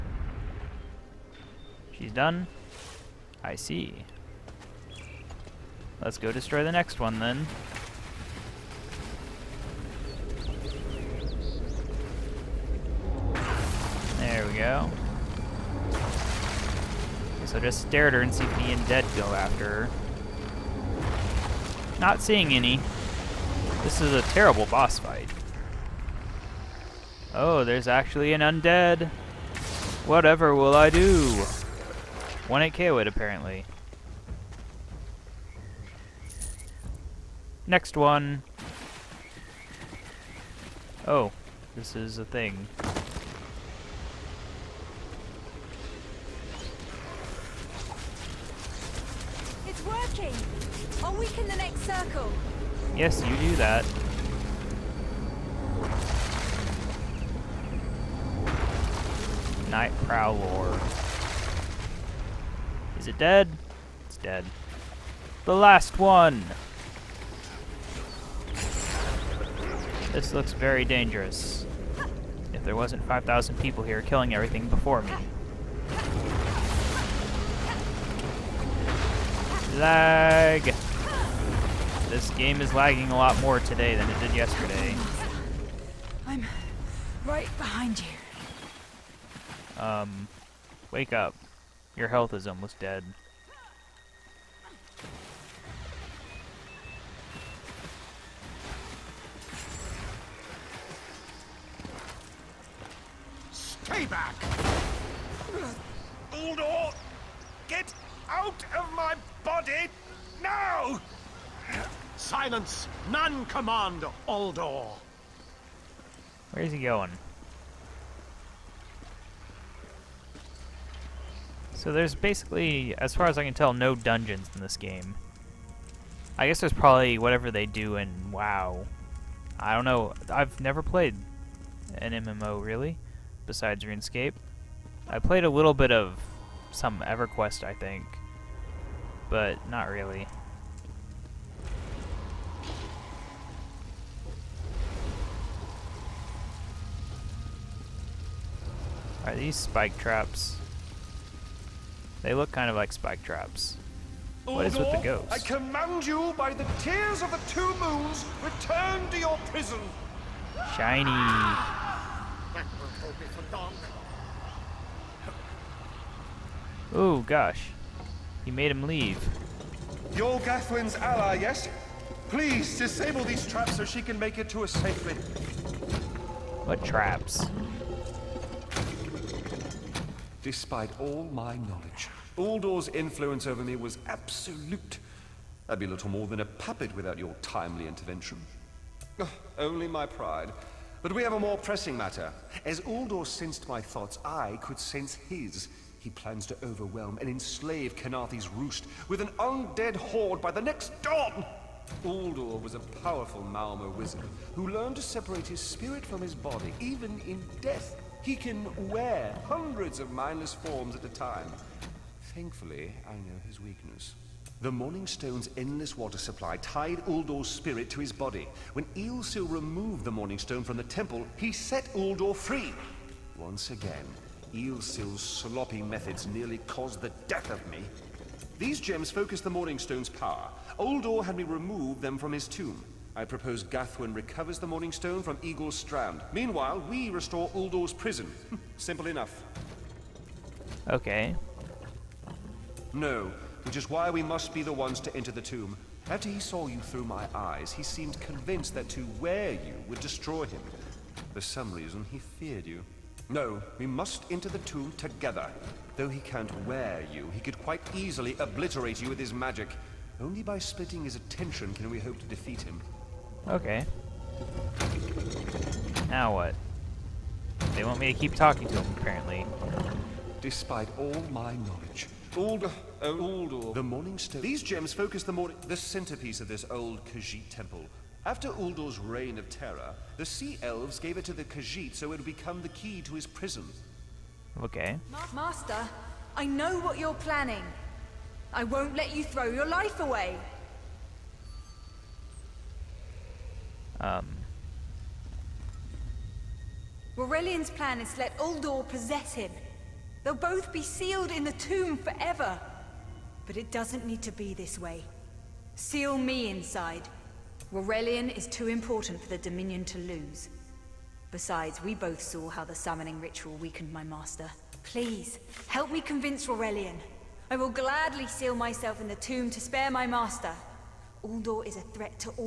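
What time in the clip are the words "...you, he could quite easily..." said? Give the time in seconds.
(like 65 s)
257 s.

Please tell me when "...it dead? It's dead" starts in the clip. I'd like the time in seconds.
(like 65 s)
63 s.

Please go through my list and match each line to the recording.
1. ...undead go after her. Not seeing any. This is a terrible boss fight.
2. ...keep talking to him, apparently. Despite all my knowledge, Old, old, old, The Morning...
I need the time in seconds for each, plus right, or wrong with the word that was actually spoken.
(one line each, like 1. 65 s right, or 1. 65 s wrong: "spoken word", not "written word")
1. 18 s right
2. 268 s right.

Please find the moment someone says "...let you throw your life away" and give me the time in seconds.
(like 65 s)
288 s.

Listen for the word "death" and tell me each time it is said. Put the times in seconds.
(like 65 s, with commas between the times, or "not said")
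207 s, 227 s.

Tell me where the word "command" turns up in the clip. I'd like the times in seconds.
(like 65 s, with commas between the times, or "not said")
113 s, 155 s.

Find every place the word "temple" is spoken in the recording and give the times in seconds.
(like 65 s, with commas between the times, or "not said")
220 s, 277 s.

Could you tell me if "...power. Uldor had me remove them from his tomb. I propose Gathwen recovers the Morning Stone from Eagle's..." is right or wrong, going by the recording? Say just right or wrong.
right.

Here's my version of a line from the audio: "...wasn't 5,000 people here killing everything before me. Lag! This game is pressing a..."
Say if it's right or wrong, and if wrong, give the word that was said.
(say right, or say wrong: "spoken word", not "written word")
wrong: "lagging", not "pressing".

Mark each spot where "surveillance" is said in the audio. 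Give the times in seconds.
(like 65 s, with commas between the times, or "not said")
not said.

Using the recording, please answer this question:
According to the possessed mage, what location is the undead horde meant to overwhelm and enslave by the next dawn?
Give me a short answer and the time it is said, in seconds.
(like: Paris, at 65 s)
Khenarthi's Roost, at 197 s.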